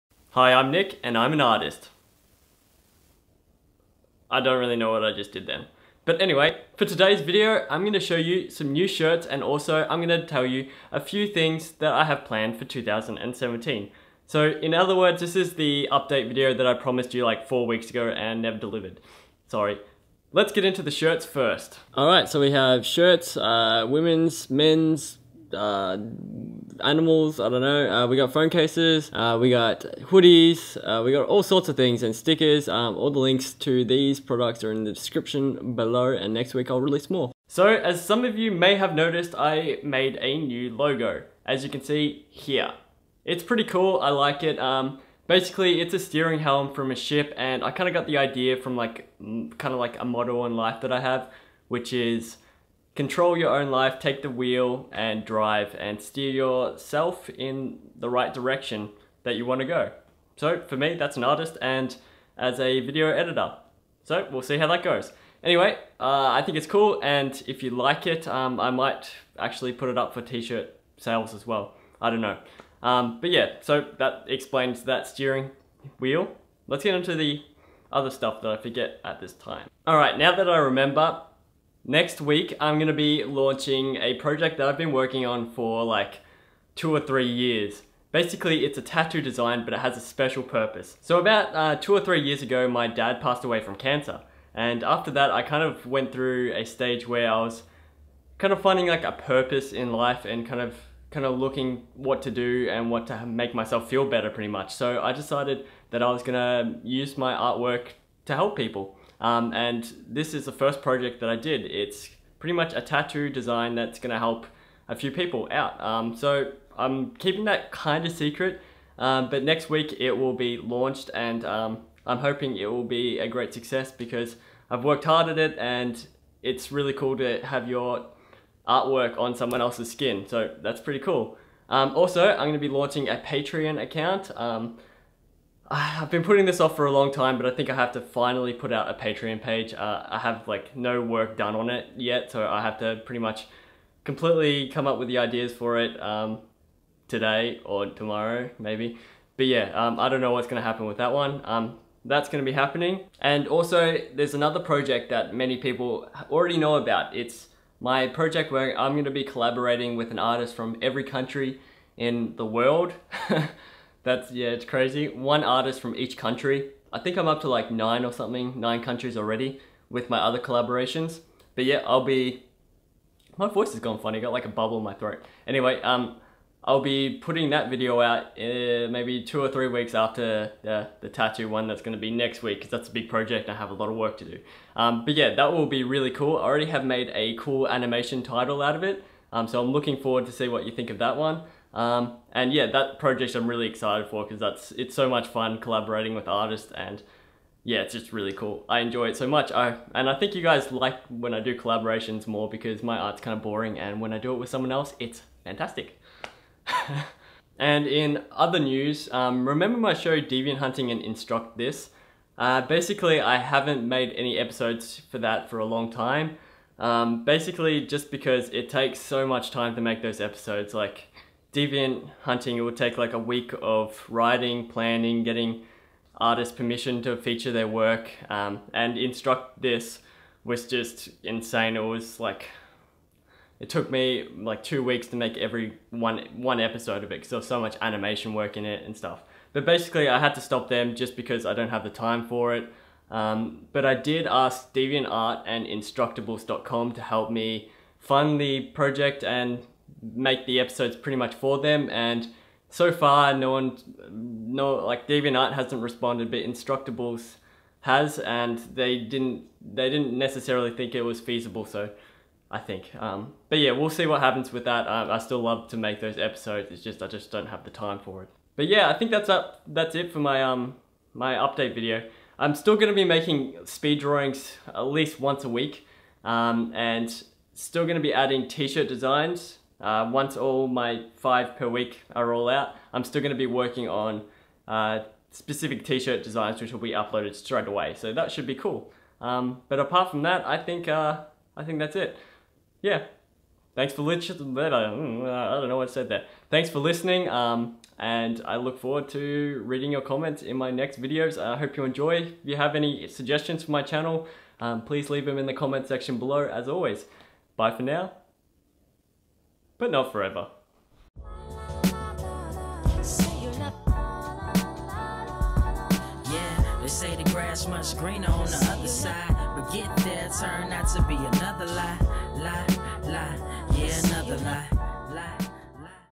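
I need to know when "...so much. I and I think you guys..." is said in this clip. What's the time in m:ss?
3:19.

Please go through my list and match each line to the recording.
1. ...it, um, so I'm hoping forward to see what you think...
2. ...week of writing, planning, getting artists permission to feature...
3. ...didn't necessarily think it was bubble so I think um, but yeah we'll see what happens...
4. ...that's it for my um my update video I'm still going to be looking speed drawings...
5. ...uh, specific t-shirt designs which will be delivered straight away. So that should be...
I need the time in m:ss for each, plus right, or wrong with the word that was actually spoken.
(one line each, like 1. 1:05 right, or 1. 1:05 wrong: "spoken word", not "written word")
1. 3:08 wrong: "looking", not "hoping"
2. 3:43 right
3. 4:19 wrong: "feasible", not "bubble"
4. 4:29 wrong: "making", not "looking"
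5. 4:44 wrong: "uploaded", not "delivered".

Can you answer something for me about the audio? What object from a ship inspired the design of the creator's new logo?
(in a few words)
steering helm.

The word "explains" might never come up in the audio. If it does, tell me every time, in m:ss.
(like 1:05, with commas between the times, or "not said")
1:14.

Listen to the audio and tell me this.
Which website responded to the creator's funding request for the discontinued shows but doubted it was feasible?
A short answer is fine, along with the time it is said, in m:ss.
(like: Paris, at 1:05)
Instructables.com, at 4:05.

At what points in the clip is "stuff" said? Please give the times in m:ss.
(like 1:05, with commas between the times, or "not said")
1:18, 3:58.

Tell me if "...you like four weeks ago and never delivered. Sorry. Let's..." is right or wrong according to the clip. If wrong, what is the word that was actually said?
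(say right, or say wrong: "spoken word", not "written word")
right.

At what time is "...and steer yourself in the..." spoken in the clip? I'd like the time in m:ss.
0:55.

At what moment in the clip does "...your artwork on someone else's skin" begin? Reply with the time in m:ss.
2:07.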